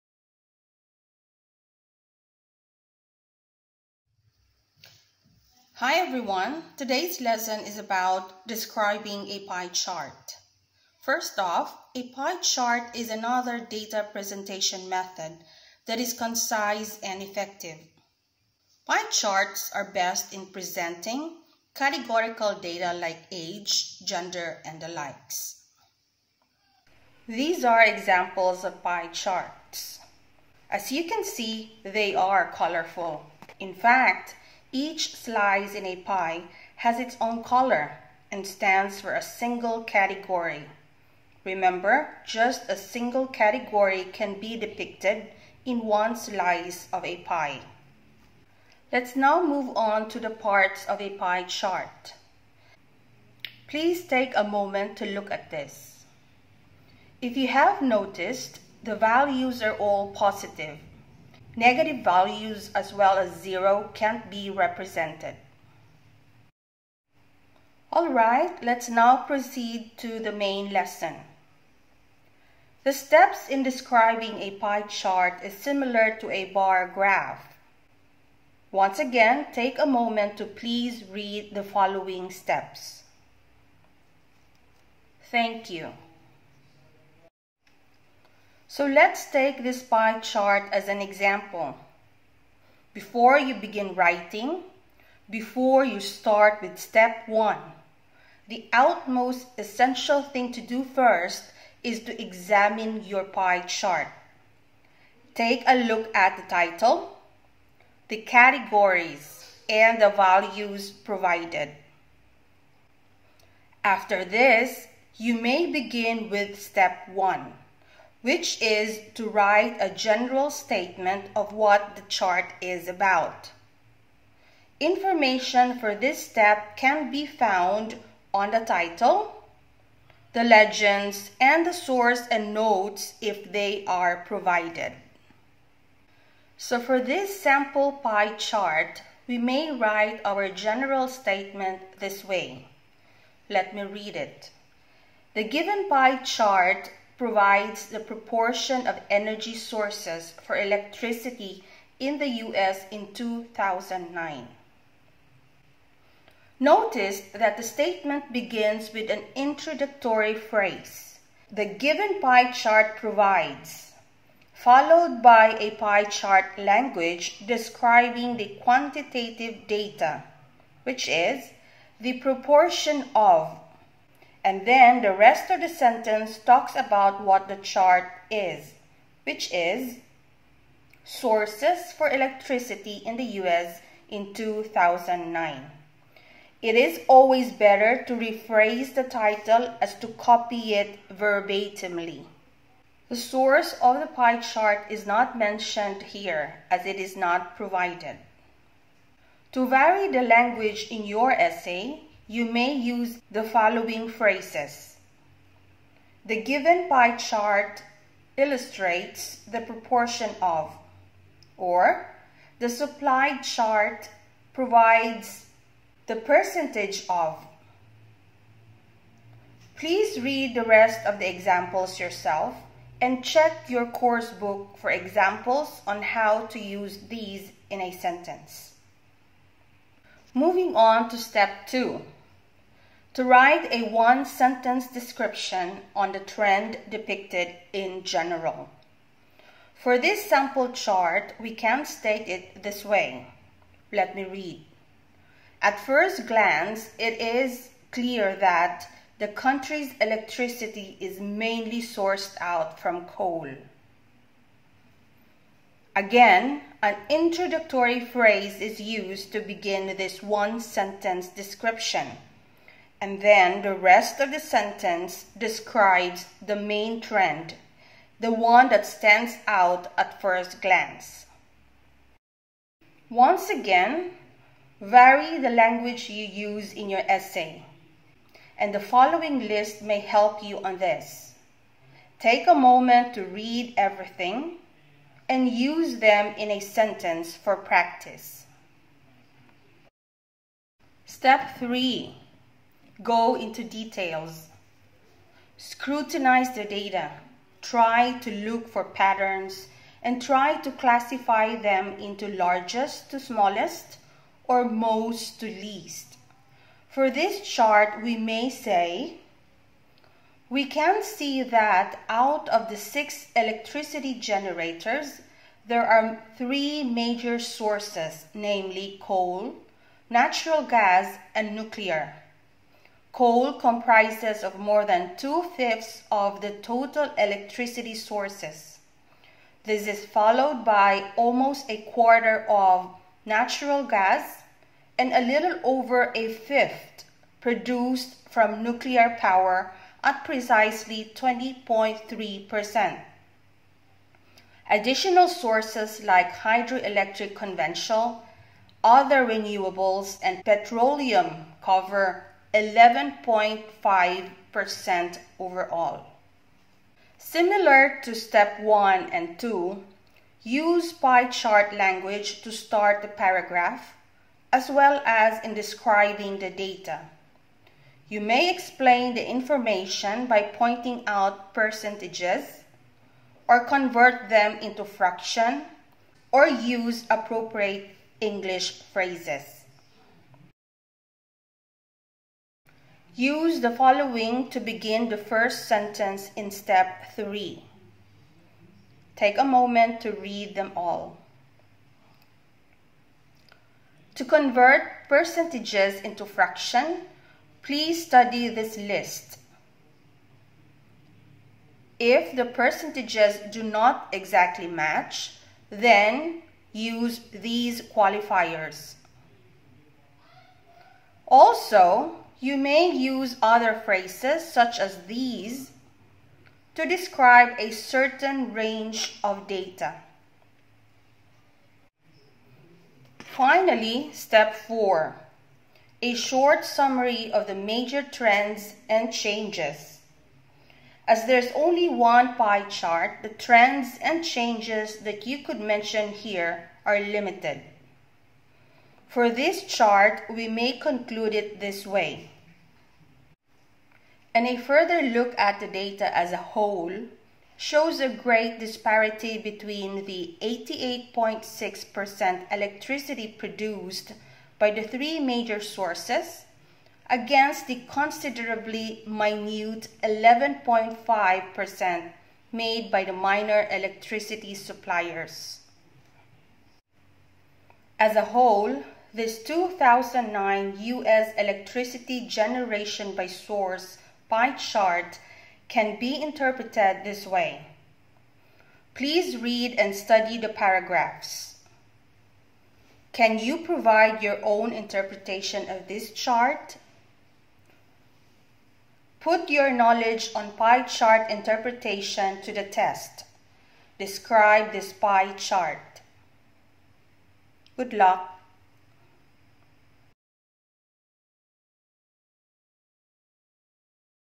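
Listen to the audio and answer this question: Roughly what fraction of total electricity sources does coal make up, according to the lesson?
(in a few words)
More than two-fifths.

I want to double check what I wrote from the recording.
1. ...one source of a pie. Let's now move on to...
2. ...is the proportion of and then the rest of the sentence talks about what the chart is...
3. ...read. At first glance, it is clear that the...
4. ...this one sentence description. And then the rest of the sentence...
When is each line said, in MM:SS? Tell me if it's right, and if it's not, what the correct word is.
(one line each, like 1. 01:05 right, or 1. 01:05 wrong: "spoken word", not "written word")
1. 00:45 wrong: "slice", not "source"
2. 02:51 right
3. 04:04 right
4. 04:19 right.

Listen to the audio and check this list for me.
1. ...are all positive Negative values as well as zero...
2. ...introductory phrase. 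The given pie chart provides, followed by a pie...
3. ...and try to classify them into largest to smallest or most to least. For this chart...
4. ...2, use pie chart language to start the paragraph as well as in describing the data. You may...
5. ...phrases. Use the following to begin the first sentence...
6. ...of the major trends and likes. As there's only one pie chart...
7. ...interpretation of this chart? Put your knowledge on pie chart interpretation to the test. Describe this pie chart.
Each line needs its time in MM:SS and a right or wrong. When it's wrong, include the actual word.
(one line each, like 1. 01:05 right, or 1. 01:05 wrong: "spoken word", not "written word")
1. 00:59 right
2. 02:39 right
3. 05:00 right
4. 05:59 right
5. 06:18 right
6. 07:07 wrong: "changes", not "likes"
7. 08:04 right.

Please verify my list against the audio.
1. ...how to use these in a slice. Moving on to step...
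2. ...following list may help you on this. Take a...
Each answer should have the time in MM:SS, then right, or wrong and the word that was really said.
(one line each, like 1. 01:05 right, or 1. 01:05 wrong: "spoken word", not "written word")
1. 03:46 wrong: "sentence", not "slice"
2. 04:38 right.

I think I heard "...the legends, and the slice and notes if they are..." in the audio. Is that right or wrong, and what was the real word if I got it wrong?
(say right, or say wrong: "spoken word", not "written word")
wrong: "source", not "slice".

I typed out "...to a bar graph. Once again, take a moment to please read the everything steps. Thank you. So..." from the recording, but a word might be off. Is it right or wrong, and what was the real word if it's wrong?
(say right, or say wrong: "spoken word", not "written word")
wrong: "following", not "everything".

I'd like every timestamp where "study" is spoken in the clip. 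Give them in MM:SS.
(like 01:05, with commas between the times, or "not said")
06:38, 07:59.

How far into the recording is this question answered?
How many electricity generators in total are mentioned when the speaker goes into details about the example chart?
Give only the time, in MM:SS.
05:12.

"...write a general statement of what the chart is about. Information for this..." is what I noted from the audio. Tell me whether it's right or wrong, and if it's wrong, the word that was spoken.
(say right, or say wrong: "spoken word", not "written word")
right.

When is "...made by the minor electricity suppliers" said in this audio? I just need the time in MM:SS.
07:42.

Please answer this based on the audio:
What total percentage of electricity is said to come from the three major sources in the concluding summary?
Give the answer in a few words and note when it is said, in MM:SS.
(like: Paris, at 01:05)
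88.6%, at 07:30.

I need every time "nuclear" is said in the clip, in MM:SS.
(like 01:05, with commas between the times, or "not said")
05:21, 05:38.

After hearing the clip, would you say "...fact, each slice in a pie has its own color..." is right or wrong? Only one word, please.
right.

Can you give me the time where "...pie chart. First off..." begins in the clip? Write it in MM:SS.
00:09.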